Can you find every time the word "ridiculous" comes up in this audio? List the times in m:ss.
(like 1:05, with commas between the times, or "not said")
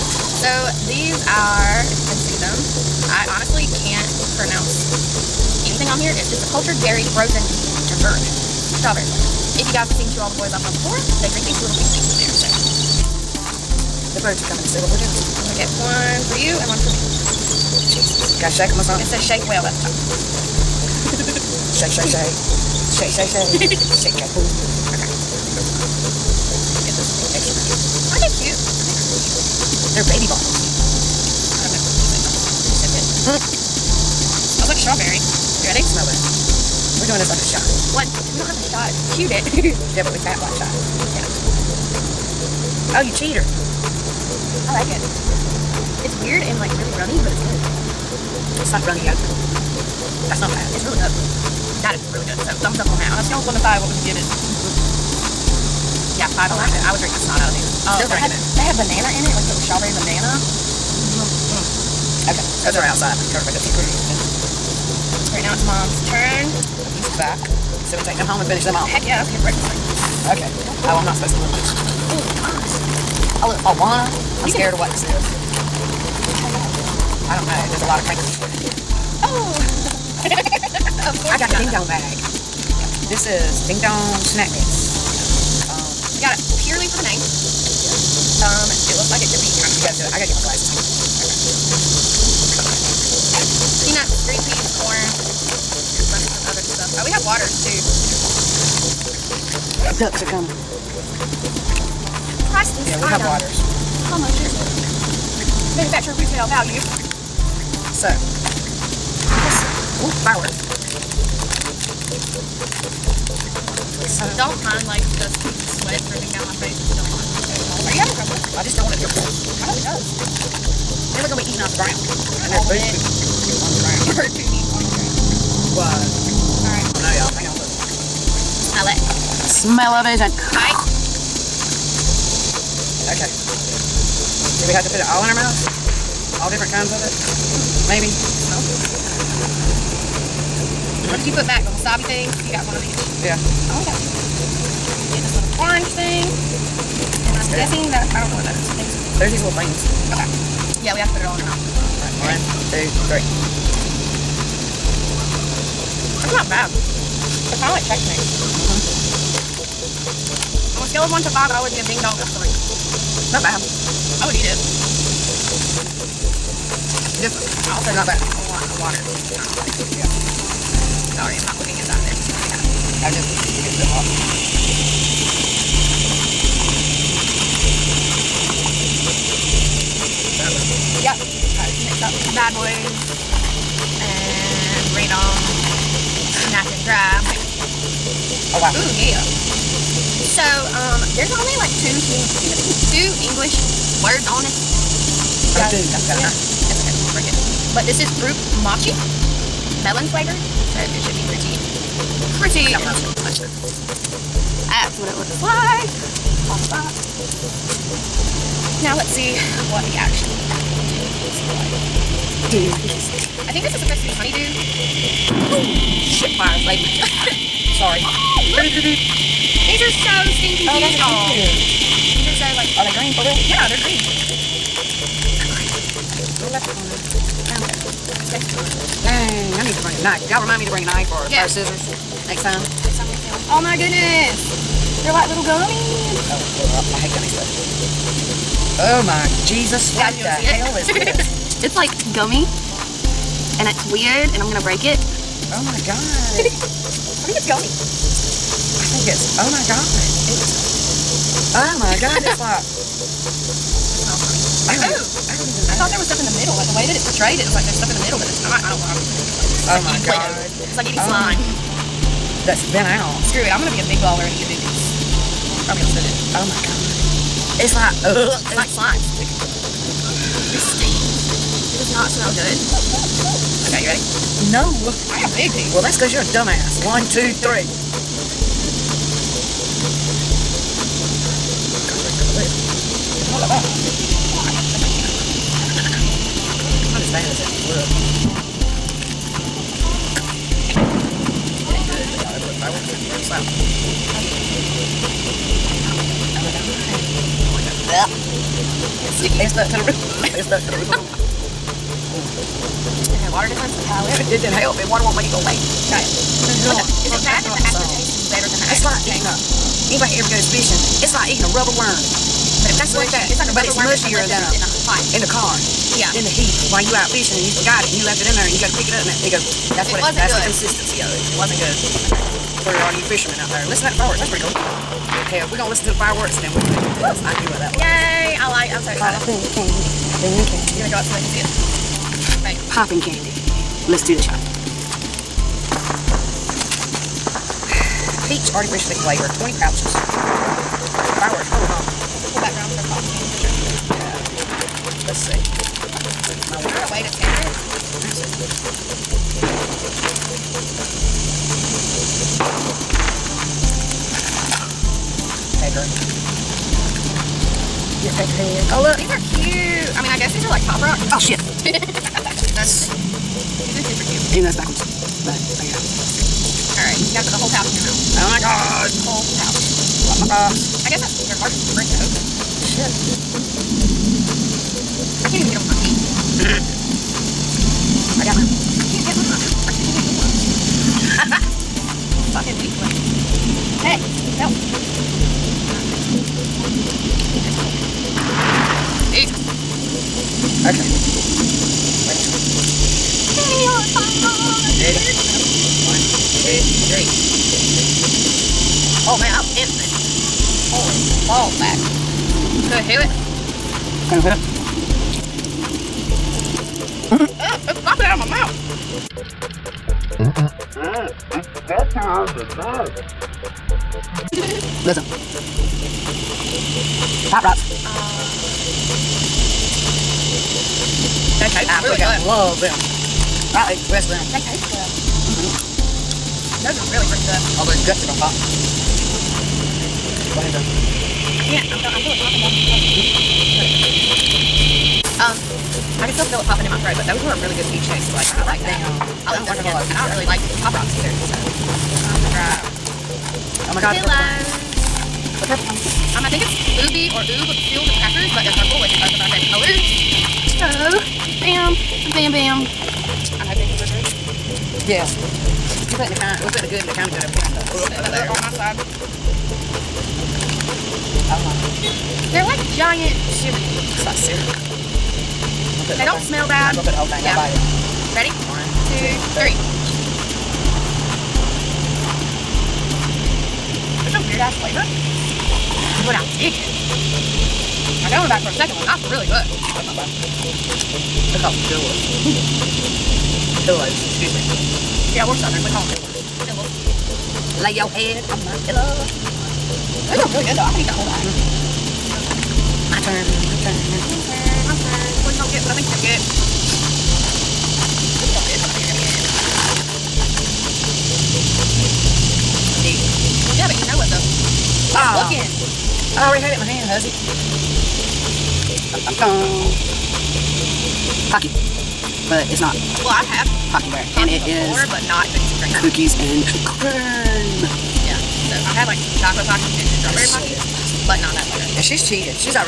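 not said.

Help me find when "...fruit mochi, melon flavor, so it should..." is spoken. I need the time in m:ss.
3:18.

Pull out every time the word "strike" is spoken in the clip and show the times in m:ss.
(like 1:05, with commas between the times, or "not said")
not said.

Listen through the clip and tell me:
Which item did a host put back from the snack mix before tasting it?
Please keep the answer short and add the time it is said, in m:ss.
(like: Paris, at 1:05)
the wasabi thing, at 2:21.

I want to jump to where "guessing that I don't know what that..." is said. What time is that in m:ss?
2:27.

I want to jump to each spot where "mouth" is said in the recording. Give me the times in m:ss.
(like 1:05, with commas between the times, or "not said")
2:15, 2:31, 6:48.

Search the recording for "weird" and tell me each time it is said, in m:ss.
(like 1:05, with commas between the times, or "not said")
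0:46, 4:03, 7:54.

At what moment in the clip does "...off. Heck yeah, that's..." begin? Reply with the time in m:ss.
1:08.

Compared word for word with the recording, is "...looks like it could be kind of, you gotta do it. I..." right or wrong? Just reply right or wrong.
right.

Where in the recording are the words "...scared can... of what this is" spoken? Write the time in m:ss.
1:14.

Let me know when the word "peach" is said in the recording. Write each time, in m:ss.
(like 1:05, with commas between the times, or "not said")
5:38, 7:17.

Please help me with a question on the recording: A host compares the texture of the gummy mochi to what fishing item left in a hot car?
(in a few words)
rubber worm.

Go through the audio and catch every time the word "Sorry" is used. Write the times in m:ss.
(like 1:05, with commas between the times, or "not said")
2:51, 3:37.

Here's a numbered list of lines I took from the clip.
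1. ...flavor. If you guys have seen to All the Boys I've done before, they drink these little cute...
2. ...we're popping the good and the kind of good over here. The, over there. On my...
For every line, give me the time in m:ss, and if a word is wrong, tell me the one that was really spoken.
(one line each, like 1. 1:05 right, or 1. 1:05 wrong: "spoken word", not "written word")
1. 0:09 right
2. 7:36 wrong: "putting", not "popping".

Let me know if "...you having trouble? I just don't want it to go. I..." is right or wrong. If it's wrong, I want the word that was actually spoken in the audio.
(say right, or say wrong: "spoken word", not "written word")
right.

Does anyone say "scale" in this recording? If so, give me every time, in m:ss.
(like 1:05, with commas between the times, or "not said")
0:53, 2:40.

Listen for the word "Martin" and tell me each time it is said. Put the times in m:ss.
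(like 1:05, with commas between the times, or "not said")
6:11.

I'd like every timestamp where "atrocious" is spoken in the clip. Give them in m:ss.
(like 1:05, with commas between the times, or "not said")
not said.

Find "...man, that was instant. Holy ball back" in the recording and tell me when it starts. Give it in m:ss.
6:39.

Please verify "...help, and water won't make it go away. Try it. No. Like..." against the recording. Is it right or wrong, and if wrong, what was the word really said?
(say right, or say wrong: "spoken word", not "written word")
right.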